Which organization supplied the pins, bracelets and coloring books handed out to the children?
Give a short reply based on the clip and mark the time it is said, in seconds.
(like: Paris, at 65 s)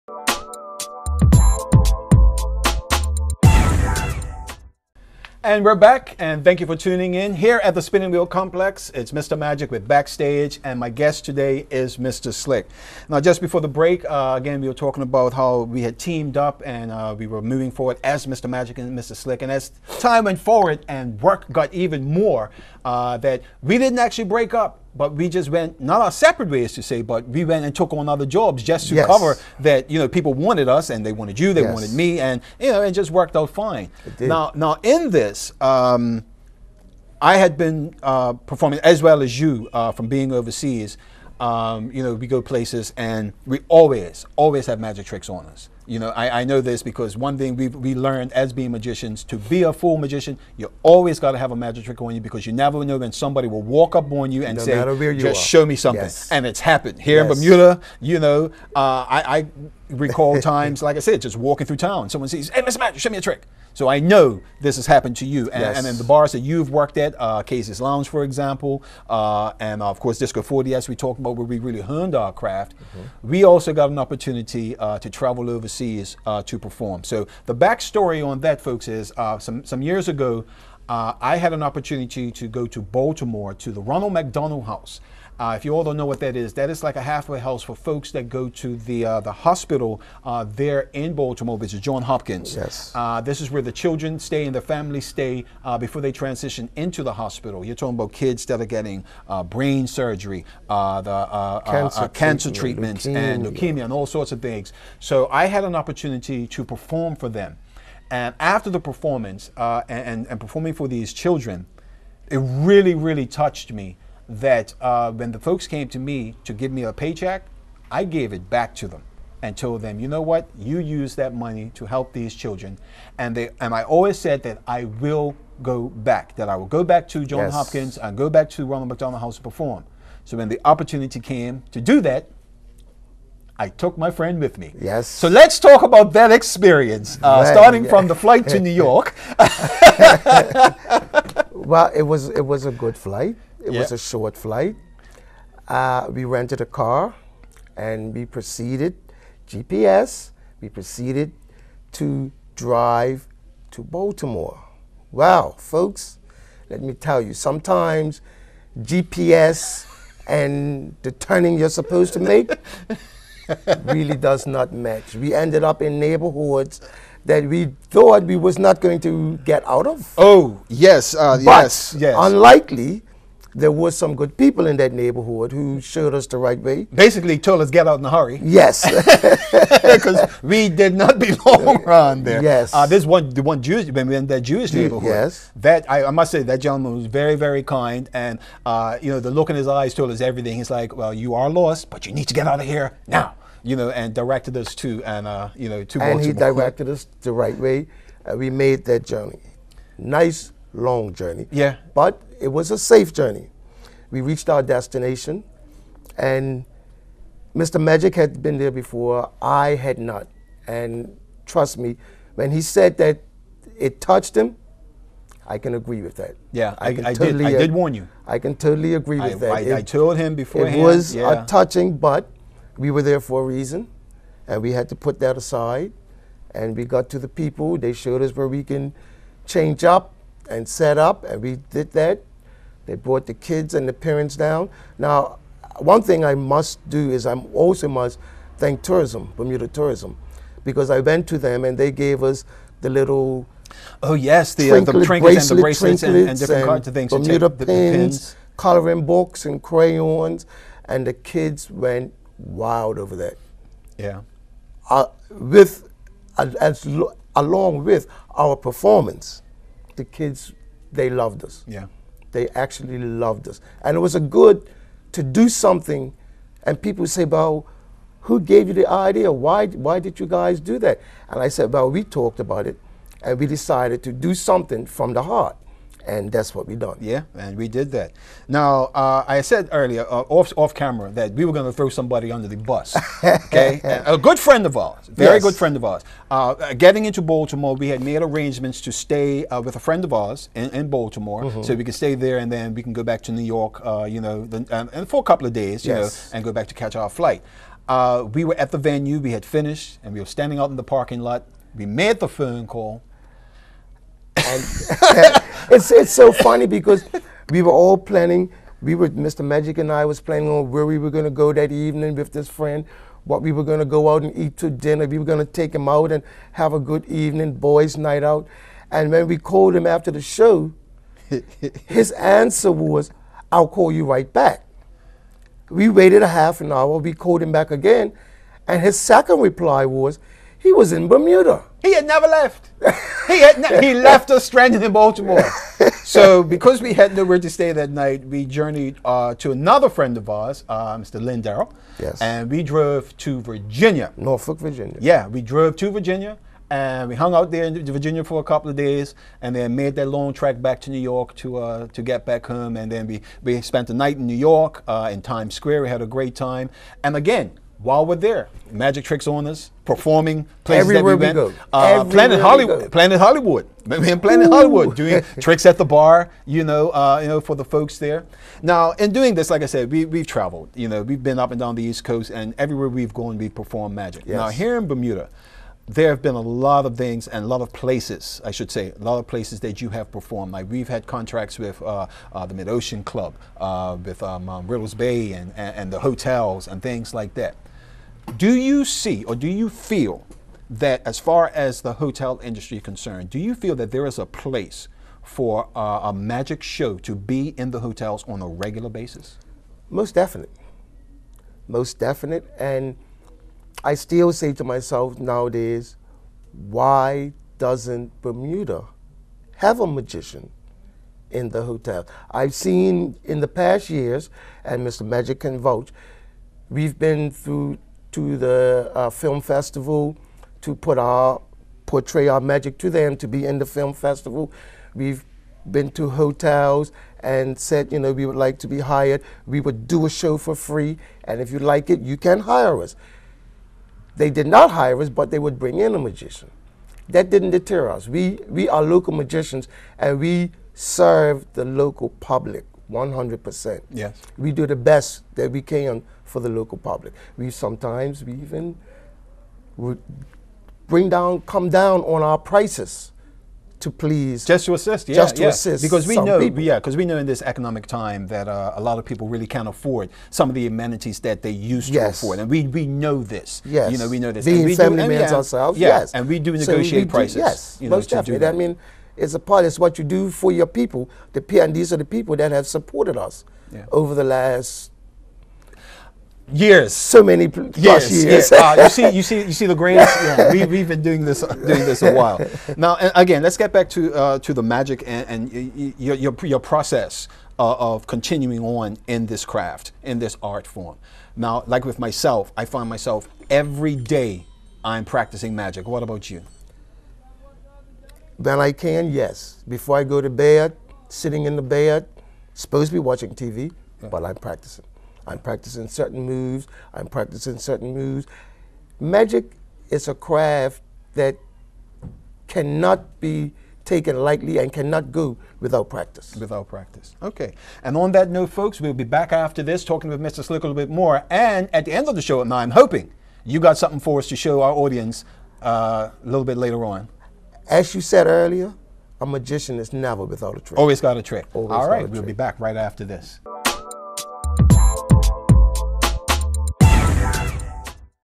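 Bermuda Tourism, at 239 s.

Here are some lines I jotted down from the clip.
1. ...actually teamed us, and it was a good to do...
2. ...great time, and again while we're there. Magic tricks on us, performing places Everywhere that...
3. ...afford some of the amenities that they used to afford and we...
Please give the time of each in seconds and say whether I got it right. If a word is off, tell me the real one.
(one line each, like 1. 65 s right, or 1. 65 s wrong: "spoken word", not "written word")
1. 262 s wrong: "loved", not "teamed"
2. 356 s right
3. 459 s right.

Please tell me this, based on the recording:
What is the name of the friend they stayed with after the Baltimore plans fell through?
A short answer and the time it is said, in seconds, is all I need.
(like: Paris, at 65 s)
Lynn Darrell, at 341 s.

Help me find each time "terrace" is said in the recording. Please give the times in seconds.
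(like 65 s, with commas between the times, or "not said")
not said.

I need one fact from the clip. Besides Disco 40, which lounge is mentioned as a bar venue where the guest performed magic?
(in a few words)
Casey's Lounge.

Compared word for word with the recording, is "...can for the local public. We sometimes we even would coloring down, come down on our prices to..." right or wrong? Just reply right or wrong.
wrong.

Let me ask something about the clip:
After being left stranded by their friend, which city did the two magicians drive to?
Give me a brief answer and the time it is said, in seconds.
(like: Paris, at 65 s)
Norfolk, Virginia, at 344 s.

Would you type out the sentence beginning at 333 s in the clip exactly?
he had ne- he left us stranded in Baltimore.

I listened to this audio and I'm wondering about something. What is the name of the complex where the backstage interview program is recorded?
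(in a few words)
Spinning Wheel Complex.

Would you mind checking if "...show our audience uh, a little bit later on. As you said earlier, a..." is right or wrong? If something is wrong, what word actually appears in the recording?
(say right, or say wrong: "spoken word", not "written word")
right.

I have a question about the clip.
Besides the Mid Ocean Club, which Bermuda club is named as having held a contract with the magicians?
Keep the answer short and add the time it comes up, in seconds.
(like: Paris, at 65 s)
Riddell's Bay, at 384 s.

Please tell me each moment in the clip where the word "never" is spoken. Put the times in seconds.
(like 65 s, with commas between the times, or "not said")
52 s, 332 s, 529 s.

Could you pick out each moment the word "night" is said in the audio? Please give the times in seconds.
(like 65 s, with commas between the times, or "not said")
317 s, 337 s, 353 s.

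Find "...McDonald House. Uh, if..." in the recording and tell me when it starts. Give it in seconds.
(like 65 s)
84 s.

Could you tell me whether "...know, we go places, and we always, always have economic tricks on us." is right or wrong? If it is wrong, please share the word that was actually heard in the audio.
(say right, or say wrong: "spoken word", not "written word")
wrong: "magic", not "economic".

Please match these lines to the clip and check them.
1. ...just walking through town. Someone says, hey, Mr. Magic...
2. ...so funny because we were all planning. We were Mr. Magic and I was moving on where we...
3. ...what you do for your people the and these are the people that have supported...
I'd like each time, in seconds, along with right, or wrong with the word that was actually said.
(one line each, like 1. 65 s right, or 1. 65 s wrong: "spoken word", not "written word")
1. 61 s right
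2. 306 s wrong: "planning", not "moving"
3. 469 s right.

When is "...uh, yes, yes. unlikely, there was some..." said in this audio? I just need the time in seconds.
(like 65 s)
171 s.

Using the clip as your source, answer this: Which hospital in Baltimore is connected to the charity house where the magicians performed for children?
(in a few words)
John Hopkins.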